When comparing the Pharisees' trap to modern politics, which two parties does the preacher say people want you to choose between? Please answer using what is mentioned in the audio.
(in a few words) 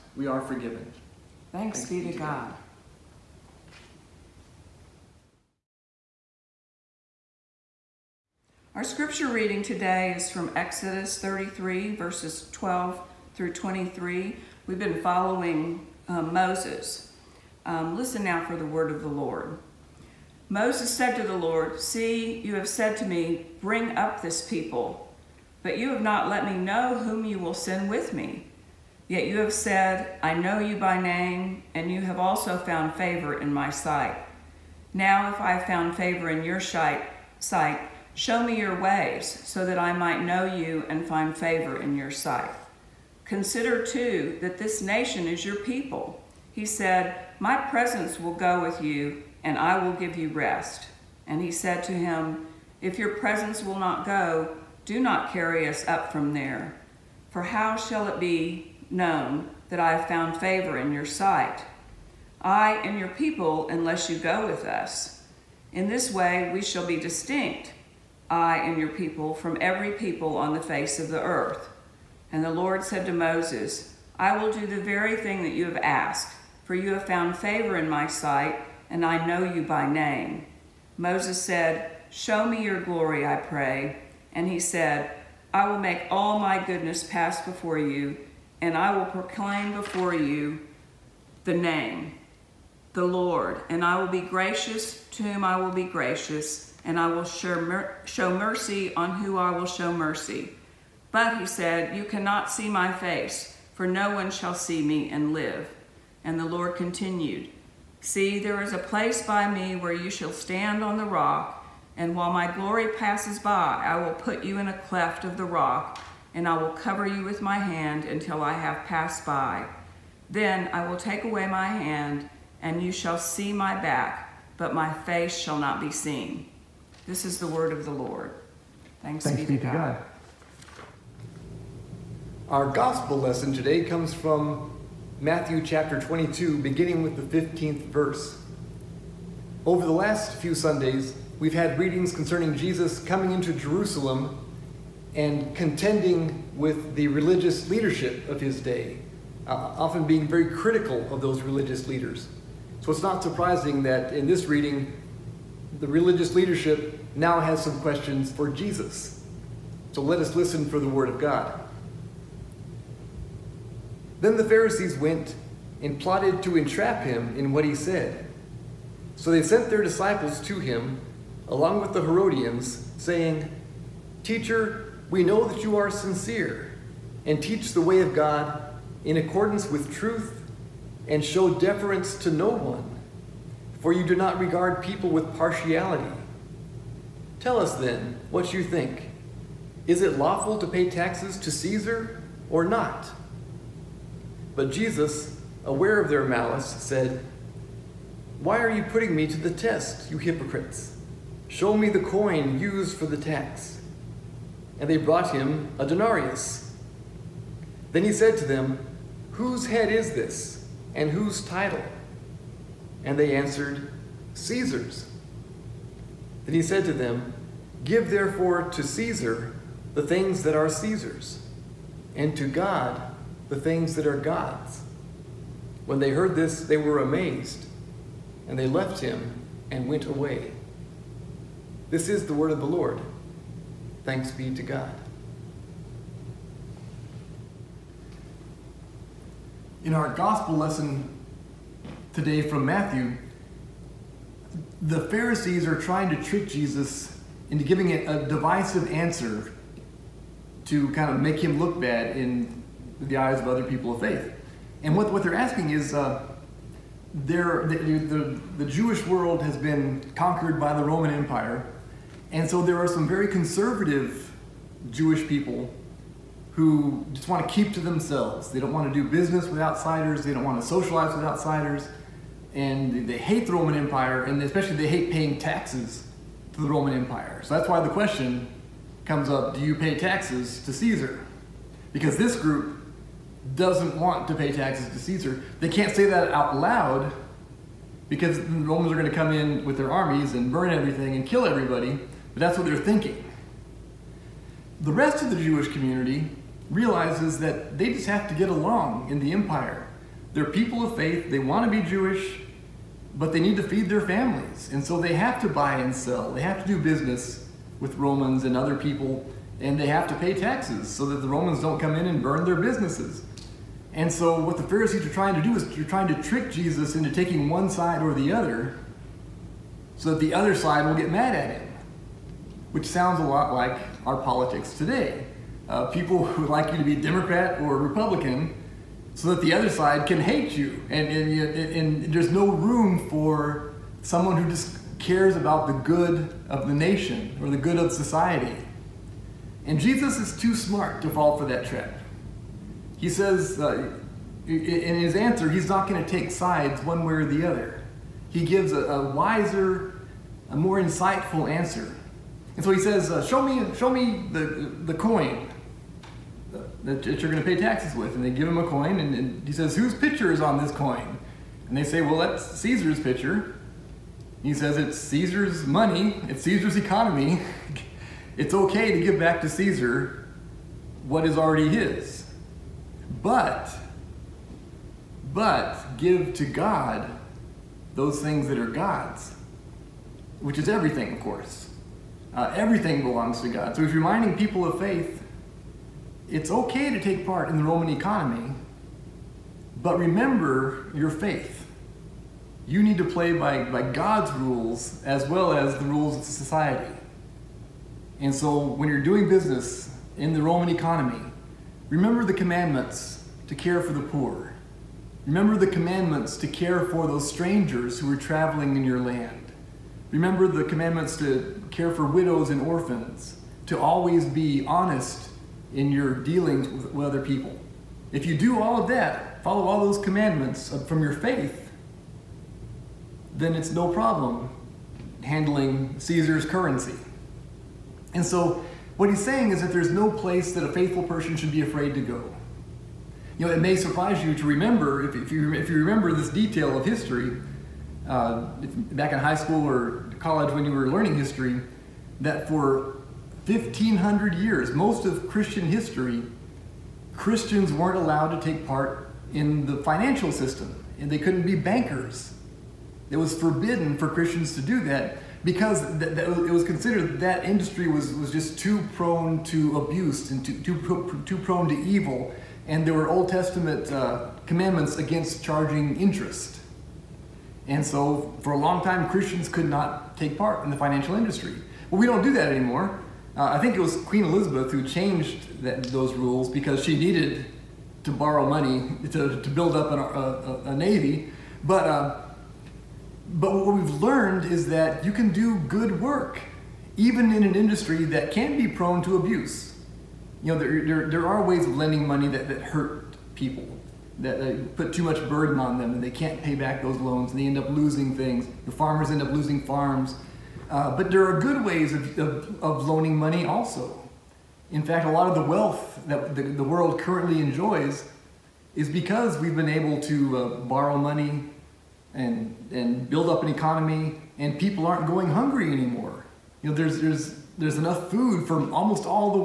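Democrat or Republican.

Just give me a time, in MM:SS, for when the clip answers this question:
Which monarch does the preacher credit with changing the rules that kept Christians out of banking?
07:54.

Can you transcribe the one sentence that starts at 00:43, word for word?
Consider too that this nation is your people.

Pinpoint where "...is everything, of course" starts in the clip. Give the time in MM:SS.
06:20.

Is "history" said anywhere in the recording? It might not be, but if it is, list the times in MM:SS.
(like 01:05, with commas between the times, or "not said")
07:16, 07:21, 07:25.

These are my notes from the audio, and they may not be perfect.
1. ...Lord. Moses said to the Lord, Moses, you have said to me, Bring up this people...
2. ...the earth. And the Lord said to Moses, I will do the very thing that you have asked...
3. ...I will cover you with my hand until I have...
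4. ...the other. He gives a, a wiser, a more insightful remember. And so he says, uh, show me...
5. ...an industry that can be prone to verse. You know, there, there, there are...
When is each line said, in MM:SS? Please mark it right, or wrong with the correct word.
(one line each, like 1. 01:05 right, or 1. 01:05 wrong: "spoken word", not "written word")
1. 00:19 wrong: "See", not "Moses"
2. 01:11 right
3. 01:56 right
4. 05:47 wrong: "answer", not "remember"
5. 08:07 wrong: "abuse", not "verse".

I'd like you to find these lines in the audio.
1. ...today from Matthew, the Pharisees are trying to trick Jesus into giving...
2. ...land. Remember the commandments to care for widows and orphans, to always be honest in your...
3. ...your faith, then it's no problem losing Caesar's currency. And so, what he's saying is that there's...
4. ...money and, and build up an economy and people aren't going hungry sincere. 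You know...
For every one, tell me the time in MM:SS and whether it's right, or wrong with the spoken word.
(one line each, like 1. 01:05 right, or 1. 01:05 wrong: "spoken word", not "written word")
1. 04:02 right
2. 06:49 right
3. 07:01 wrong: "handling", not "losing"
4. 08:30 wrong: "anymore", not "sincere".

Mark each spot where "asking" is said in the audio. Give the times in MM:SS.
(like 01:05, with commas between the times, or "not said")
04:15.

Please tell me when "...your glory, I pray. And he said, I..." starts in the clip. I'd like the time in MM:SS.
01:22.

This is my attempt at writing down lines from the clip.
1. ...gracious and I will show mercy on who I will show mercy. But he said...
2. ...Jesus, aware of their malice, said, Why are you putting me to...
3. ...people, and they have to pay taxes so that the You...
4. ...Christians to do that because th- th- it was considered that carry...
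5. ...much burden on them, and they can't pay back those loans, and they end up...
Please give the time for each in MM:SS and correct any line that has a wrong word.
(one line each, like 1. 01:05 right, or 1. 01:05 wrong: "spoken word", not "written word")
1. 01:35 right
2. 03:14 right
3. 05:08 wrong: "Romans", not "You"
4. 07:34 wrong: "industry", not "carry"
5. 08:15 right.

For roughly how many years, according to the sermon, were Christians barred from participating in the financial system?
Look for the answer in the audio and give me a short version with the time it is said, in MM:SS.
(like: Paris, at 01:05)
1,500, at 07:23.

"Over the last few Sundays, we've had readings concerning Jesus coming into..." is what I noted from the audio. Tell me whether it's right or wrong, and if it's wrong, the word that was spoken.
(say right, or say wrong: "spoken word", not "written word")
right.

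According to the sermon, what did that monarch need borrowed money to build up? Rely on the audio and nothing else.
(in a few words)
A navy.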